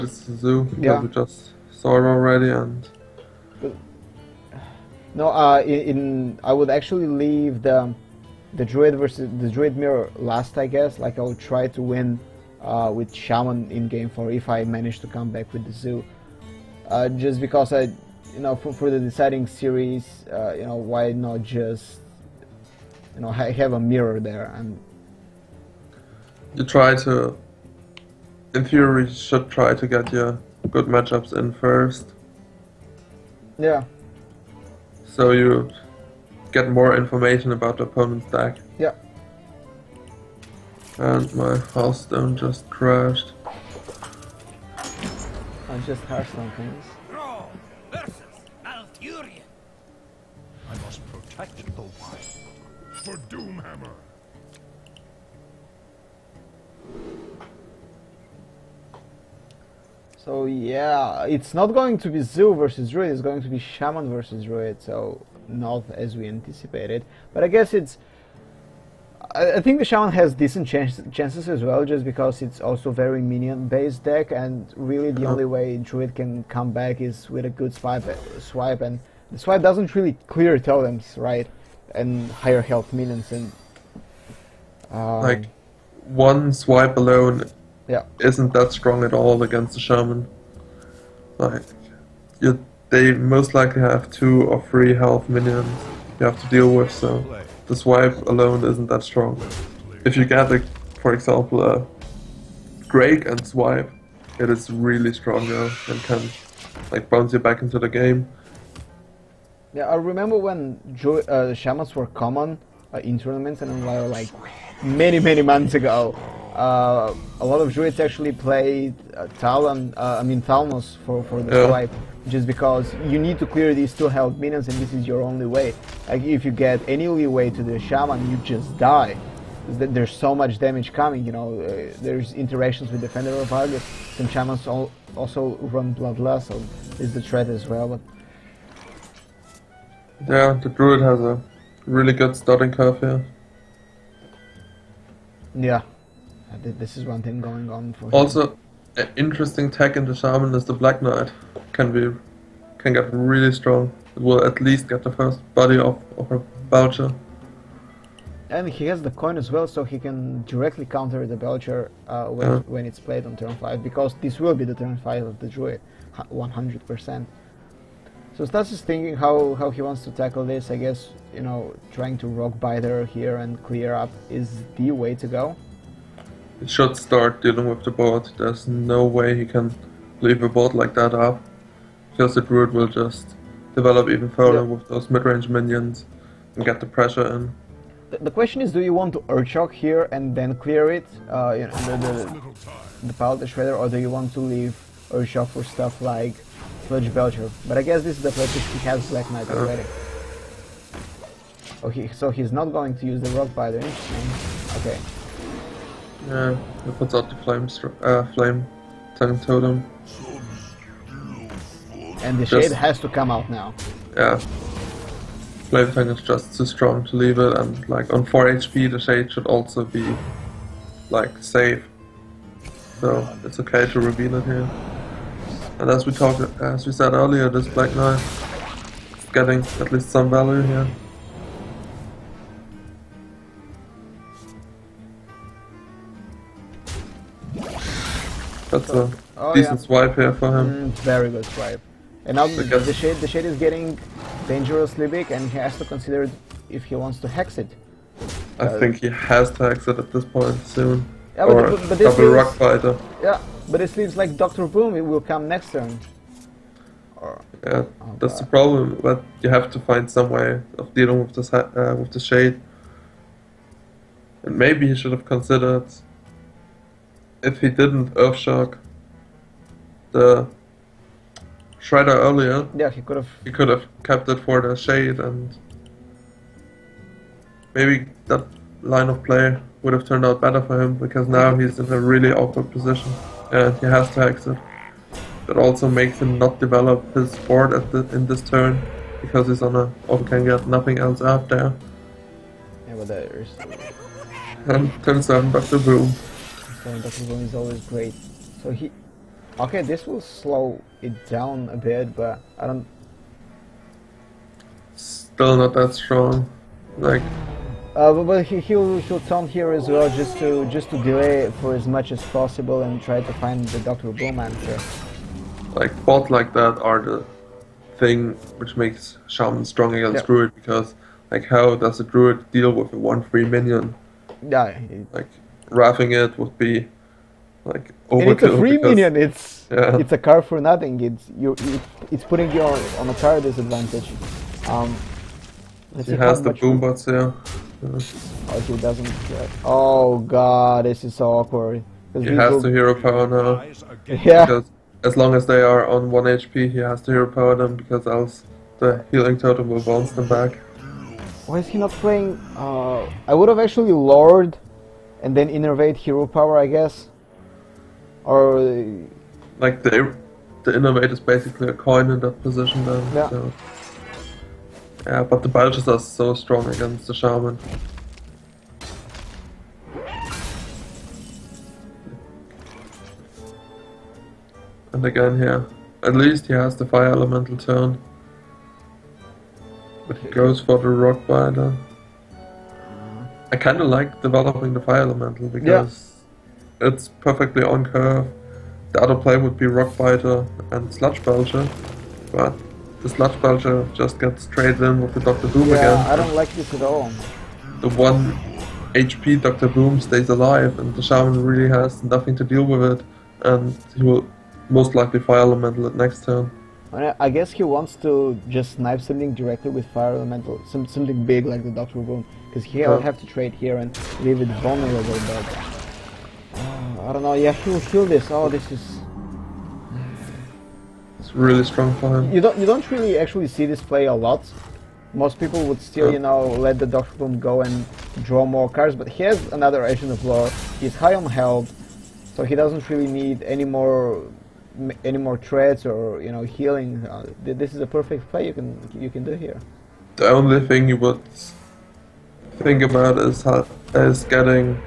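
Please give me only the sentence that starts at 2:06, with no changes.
Like if you get any leeway to the Shaman, you just die.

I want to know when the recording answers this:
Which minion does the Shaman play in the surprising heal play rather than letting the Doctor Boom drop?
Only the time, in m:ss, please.
7:09.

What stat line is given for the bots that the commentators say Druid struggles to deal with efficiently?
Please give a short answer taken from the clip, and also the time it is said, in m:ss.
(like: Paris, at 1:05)
1-3, at 5:22.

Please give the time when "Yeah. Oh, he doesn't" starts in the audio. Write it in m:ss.
5:37.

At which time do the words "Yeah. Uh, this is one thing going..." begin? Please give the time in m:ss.
2:25.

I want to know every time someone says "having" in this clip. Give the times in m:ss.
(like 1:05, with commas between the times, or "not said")
not said.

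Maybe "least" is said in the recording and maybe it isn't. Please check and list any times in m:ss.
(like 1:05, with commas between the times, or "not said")
2:34, 3:49, 6:16.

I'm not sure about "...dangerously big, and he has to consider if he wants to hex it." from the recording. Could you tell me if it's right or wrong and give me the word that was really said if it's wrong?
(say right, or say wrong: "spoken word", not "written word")
right.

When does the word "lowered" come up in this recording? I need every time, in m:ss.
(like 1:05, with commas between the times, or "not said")
5:53.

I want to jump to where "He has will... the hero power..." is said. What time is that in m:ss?
5:42.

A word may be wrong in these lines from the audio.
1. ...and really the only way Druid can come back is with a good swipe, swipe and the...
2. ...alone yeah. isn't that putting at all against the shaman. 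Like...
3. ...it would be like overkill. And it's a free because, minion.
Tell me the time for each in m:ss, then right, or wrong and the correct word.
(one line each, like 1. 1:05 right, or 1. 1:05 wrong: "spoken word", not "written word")
1. 1:14 right
2. 1:26 wrong: "strong", not "putting"
3. 5:26 right.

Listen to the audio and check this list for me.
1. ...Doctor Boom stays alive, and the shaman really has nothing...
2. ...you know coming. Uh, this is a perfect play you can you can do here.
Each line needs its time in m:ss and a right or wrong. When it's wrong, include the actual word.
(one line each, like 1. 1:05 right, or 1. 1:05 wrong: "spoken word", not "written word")
1. 6:39 right
2. 7:16 wrong: "healing", not "coming".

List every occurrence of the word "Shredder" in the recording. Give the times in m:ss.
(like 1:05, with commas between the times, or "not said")
3:13, 4:31.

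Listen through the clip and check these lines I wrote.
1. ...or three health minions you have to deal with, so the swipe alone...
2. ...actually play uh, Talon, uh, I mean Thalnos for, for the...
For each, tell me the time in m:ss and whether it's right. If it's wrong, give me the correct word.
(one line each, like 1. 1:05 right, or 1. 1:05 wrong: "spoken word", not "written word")
1. 1:34 right
2. 1:58 right.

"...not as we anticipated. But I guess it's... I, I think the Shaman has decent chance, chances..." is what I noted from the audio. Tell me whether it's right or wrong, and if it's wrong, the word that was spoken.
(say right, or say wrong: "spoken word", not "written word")
right.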